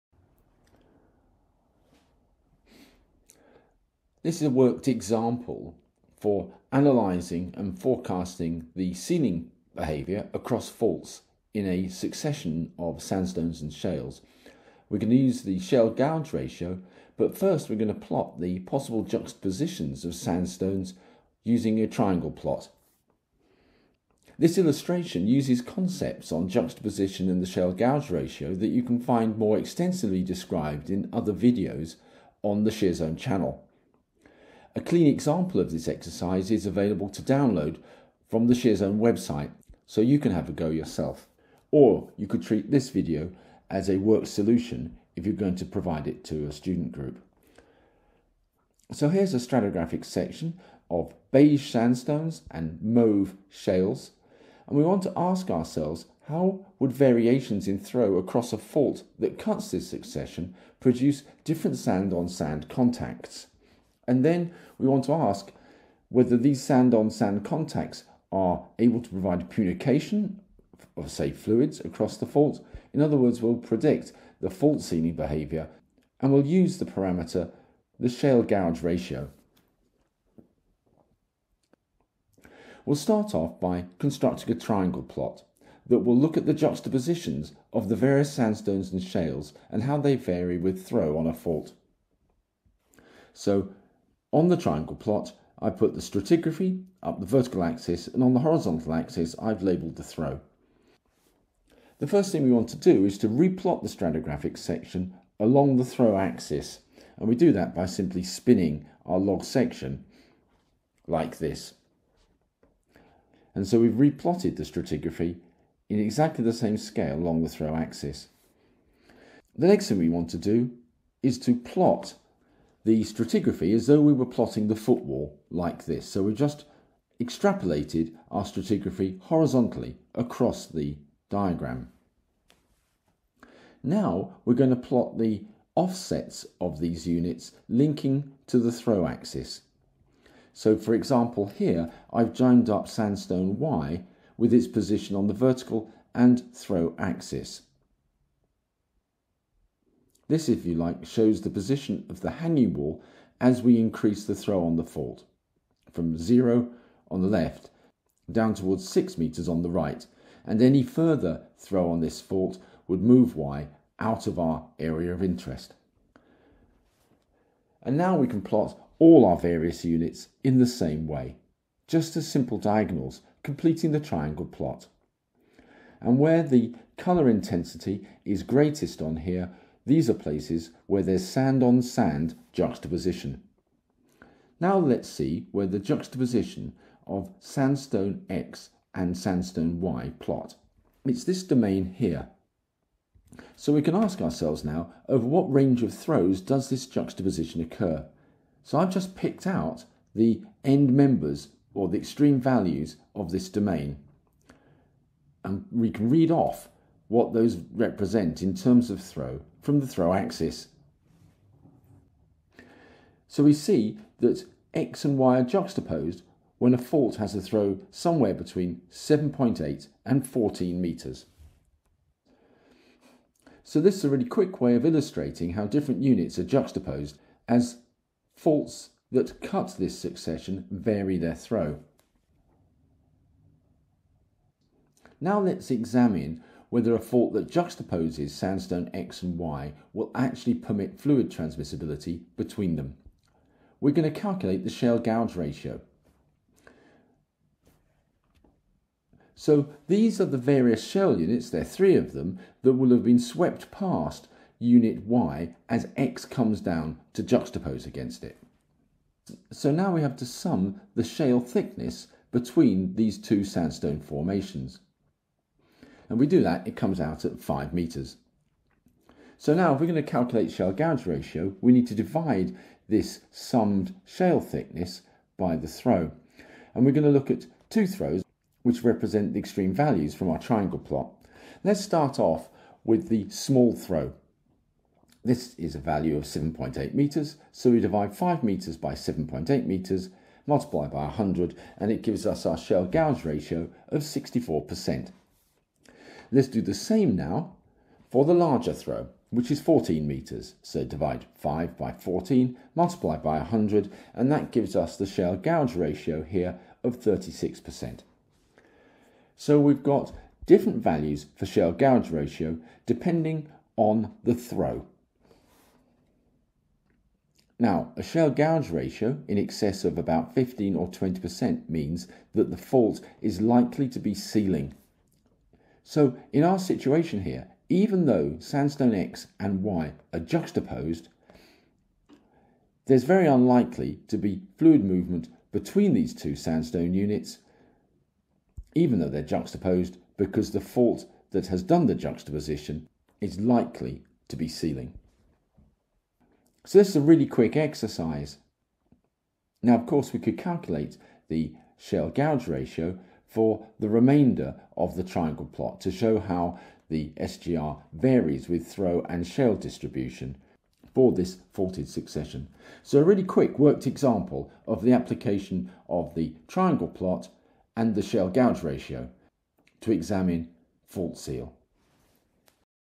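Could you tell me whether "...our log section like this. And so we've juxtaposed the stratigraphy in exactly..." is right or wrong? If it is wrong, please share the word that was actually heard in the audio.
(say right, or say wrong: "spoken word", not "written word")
wrong: "replotted", not "juxtaposed".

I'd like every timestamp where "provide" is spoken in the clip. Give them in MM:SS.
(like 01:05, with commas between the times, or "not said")
00:45, 01:09.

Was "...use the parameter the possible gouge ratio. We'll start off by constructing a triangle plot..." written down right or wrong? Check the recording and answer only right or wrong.
wrong.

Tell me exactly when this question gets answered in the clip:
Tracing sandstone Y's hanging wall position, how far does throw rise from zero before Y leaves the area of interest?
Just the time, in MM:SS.
02:38.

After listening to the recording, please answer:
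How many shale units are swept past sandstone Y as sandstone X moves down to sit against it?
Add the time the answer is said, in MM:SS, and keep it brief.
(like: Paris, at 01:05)
3, at 04:11.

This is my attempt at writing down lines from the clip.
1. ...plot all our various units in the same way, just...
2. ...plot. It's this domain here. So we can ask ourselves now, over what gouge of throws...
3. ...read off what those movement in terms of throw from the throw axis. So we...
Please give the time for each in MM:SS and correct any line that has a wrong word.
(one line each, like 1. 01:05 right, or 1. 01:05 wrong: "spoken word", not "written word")
1. 02:48 right
2. 03:10 wrong: "range", not "gouge"
3. 03:26 wrong: "represent", not "movement".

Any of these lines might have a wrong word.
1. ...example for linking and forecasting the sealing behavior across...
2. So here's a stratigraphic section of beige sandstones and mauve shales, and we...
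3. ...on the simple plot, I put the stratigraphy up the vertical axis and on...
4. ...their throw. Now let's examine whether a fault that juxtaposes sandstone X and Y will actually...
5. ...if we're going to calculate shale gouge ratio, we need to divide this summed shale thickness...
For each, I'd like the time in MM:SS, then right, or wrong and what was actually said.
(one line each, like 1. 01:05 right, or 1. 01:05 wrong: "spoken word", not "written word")
1. 00:04 wrong: "analyzing", not "linking"
2. 00:48 right
3. 01:34 wrong: "triangle", not "simple"
4. 03:51 right
5. 04:29 right.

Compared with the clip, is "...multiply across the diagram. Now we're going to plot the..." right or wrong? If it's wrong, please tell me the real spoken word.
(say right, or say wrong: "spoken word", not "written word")
wrong: "horizontally", not "multiply".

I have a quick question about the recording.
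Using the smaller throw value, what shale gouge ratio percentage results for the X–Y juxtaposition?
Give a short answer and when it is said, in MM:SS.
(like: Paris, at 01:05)
64%, at 04:54.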